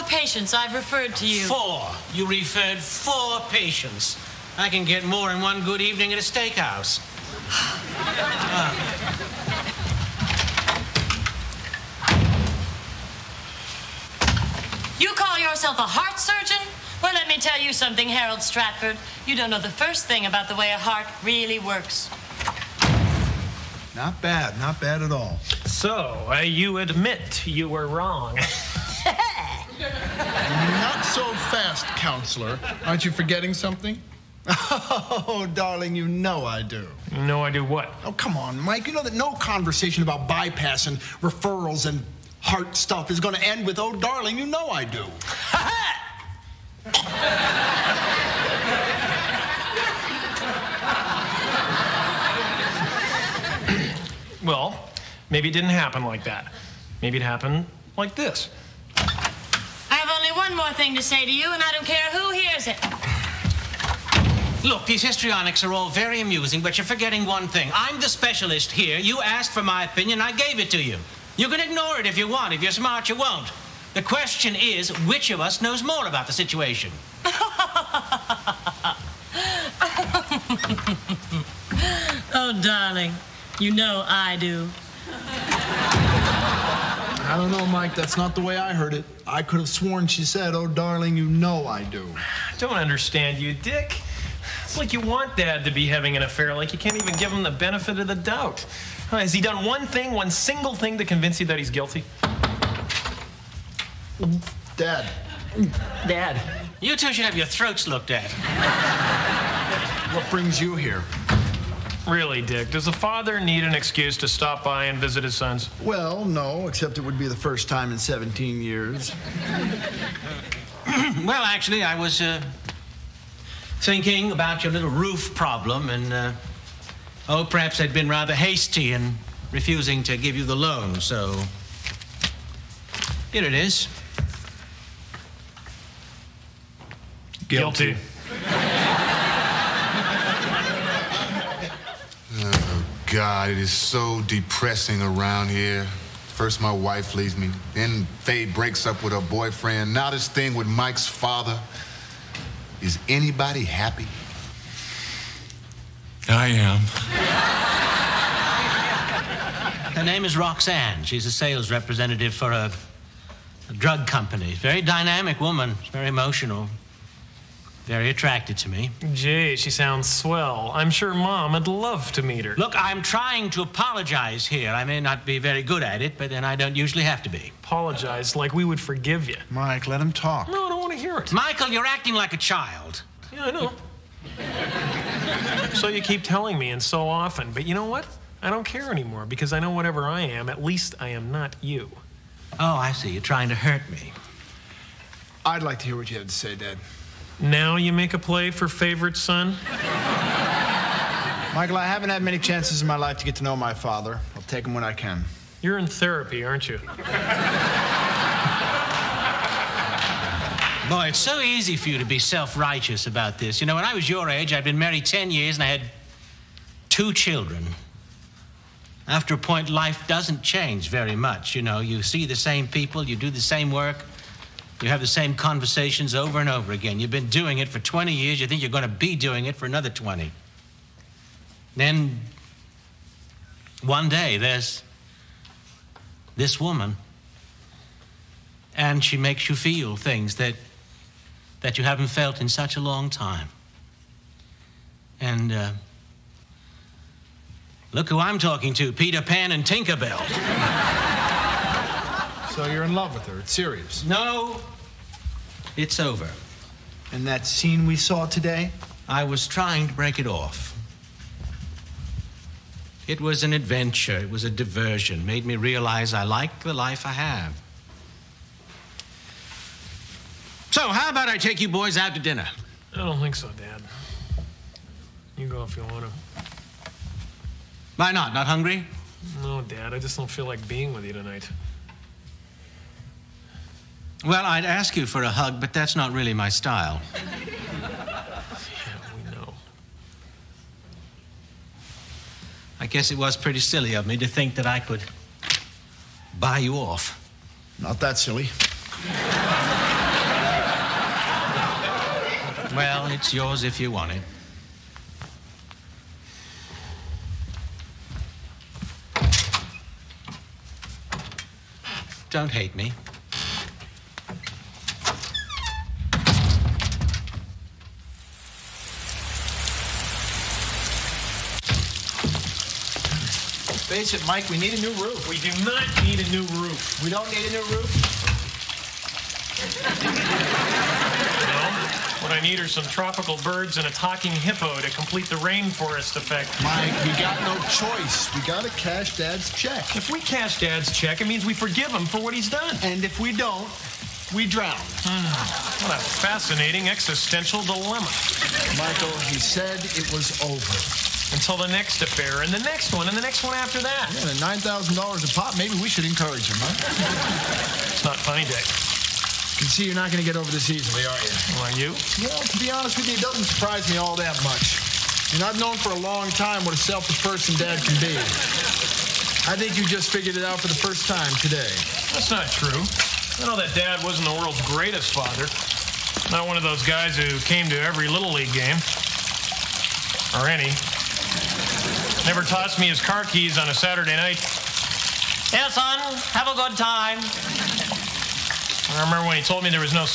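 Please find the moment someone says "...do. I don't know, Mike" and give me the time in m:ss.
1:24.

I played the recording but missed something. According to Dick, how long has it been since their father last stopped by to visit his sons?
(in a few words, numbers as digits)
17 years.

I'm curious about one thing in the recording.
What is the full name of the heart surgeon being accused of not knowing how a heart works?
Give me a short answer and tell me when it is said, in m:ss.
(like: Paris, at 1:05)
Harold Stratford, at 0:18.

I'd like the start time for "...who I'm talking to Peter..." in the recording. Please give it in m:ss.
4:08.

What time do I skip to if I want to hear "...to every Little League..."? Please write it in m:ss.
6:17.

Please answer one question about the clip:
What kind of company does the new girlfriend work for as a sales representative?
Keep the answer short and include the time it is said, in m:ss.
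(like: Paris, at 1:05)
A drug company, at 2:43.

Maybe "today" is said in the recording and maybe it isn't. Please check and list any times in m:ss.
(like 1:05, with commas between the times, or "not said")
4:18, 6:11.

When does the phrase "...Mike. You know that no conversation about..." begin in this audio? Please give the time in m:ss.
0:38.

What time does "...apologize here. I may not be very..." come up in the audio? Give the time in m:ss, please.
2:53.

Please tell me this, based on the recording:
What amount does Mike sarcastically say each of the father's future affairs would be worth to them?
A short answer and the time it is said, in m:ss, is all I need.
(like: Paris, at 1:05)
$9,000, at 5:54.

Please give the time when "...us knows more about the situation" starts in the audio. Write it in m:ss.
1:15.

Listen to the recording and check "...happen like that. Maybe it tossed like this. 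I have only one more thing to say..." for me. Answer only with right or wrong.
wrong.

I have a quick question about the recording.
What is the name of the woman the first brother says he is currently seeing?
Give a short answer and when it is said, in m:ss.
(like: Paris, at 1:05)
Roxanne, at 2:40.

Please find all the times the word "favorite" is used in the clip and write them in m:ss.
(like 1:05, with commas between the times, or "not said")
3:18.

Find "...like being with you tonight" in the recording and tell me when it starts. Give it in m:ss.
4:40.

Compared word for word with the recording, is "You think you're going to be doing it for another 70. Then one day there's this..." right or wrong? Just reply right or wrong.
wrong.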